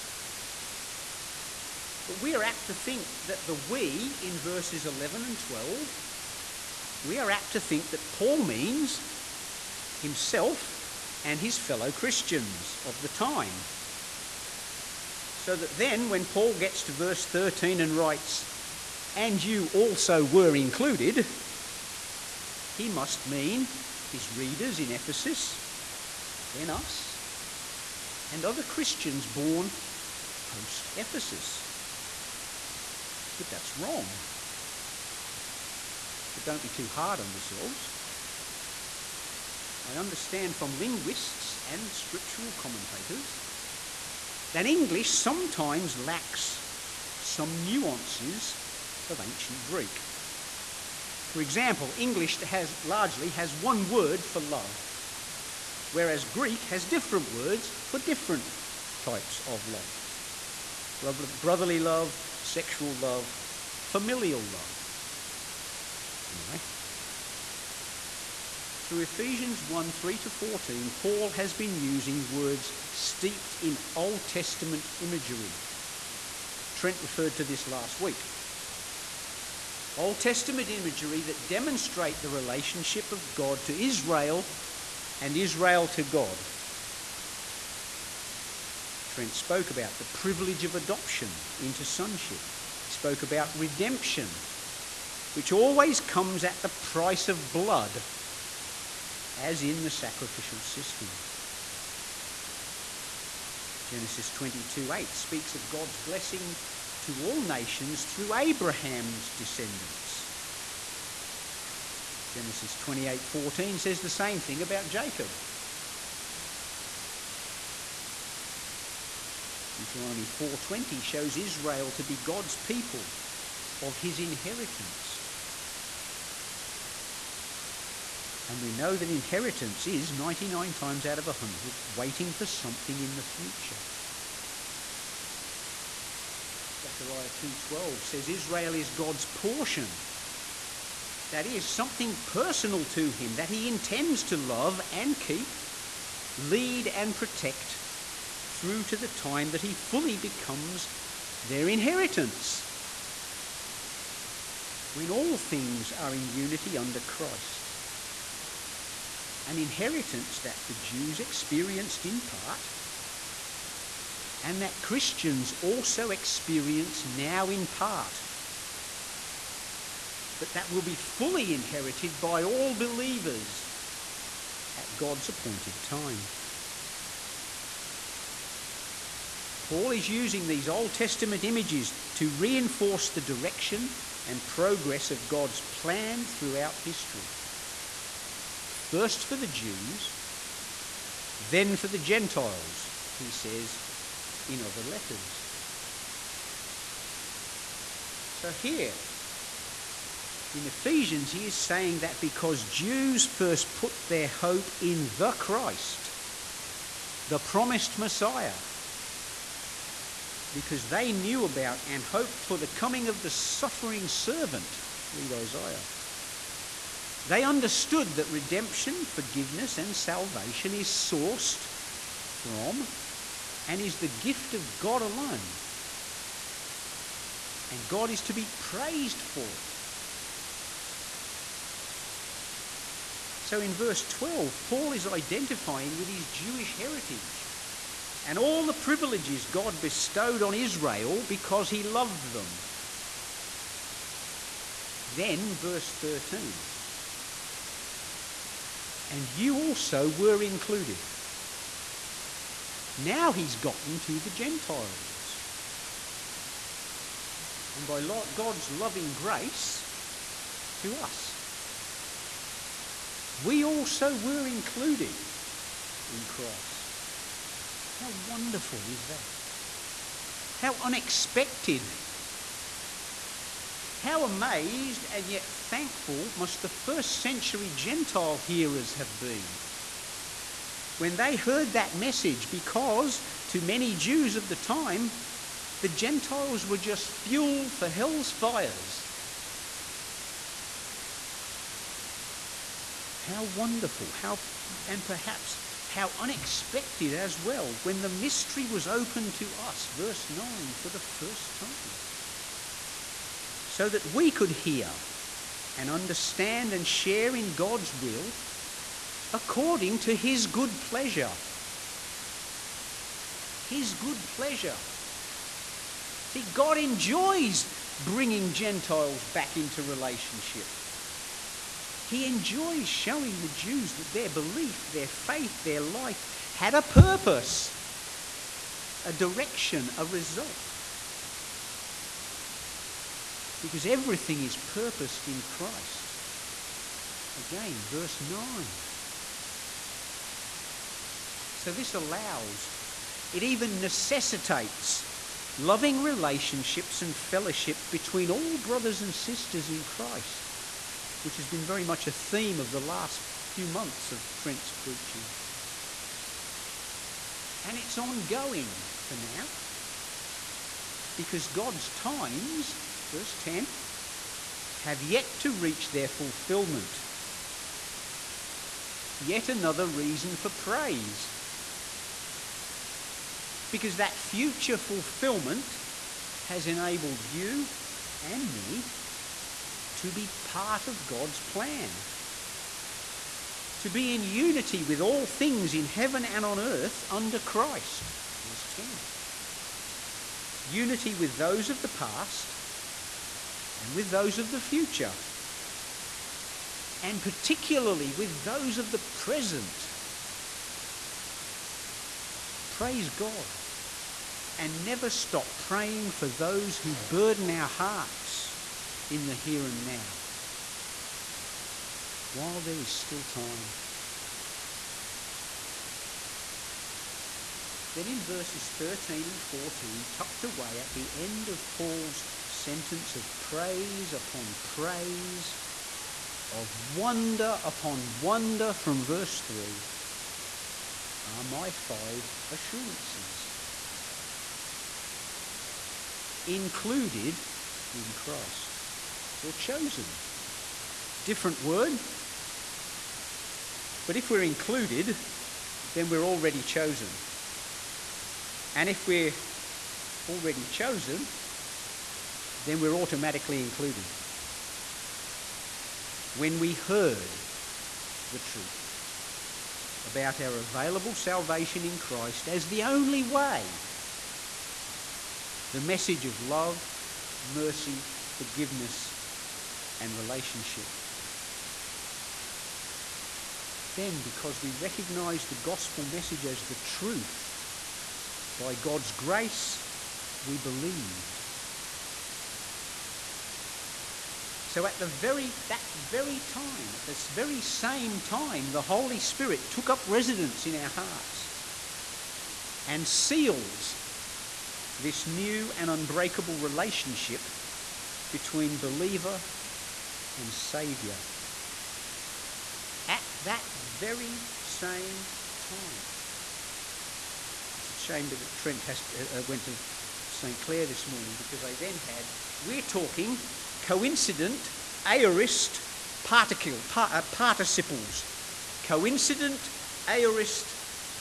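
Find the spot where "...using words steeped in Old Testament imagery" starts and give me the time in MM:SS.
01:11.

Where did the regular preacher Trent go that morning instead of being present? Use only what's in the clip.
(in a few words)
St. Clair.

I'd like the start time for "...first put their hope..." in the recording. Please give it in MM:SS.
03:23.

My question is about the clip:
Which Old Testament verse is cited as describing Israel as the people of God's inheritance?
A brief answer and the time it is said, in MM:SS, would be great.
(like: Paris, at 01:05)
Deuteronomy 4:20, at 01:59.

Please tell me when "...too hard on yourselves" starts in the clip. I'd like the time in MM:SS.
00:36.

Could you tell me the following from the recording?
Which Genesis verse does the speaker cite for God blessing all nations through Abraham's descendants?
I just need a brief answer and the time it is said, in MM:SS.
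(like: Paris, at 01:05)
Genesis 22:8, at 01:43.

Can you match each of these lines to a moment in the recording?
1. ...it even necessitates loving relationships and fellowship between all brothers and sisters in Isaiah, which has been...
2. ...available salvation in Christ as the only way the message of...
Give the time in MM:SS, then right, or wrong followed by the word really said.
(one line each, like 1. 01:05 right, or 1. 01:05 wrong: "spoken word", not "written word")
1. 05:43 wrong: "Christ", not "Isaiah"
2. 07:40 right.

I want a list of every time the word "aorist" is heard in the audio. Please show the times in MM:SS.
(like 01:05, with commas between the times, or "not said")
08:35, 08:40.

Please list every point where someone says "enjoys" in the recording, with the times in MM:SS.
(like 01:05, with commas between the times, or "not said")
05:16, 05:22.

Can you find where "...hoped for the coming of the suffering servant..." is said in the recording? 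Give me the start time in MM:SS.
03:32.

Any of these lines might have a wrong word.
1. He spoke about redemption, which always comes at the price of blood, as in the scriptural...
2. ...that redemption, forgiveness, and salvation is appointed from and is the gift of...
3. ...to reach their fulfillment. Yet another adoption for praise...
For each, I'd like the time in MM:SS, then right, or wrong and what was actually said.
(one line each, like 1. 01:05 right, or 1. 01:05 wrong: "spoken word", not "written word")
1. 01:32 wrong: "sacrificial", not "scriptural"
2. 03:38 wrong: "sourced", not "appointed"
3. 06:05 wrong: "reason", not "adoption".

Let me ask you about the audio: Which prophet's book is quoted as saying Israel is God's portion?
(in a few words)
Zechariah.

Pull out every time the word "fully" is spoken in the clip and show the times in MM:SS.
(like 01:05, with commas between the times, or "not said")
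02:29, 02:50.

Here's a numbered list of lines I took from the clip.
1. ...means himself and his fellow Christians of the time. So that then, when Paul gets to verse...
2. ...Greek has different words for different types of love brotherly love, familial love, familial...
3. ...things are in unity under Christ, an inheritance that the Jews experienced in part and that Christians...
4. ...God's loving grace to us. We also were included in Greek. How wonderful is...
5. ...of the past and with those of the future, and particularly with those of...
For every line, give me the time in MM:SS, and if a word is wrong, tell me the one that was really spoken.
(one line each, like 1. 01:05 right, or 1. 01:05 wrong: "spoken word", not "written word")
1. 00:08 right
2. 00:56 wrong: "sexual", not "familial"
3. 02:35 right
4. 04:18 wrong: "Christ", not "Greek"
5. 06:31 right.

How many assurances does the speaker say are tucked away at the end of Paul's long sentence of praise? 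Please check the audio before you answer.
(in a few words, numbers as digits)
5.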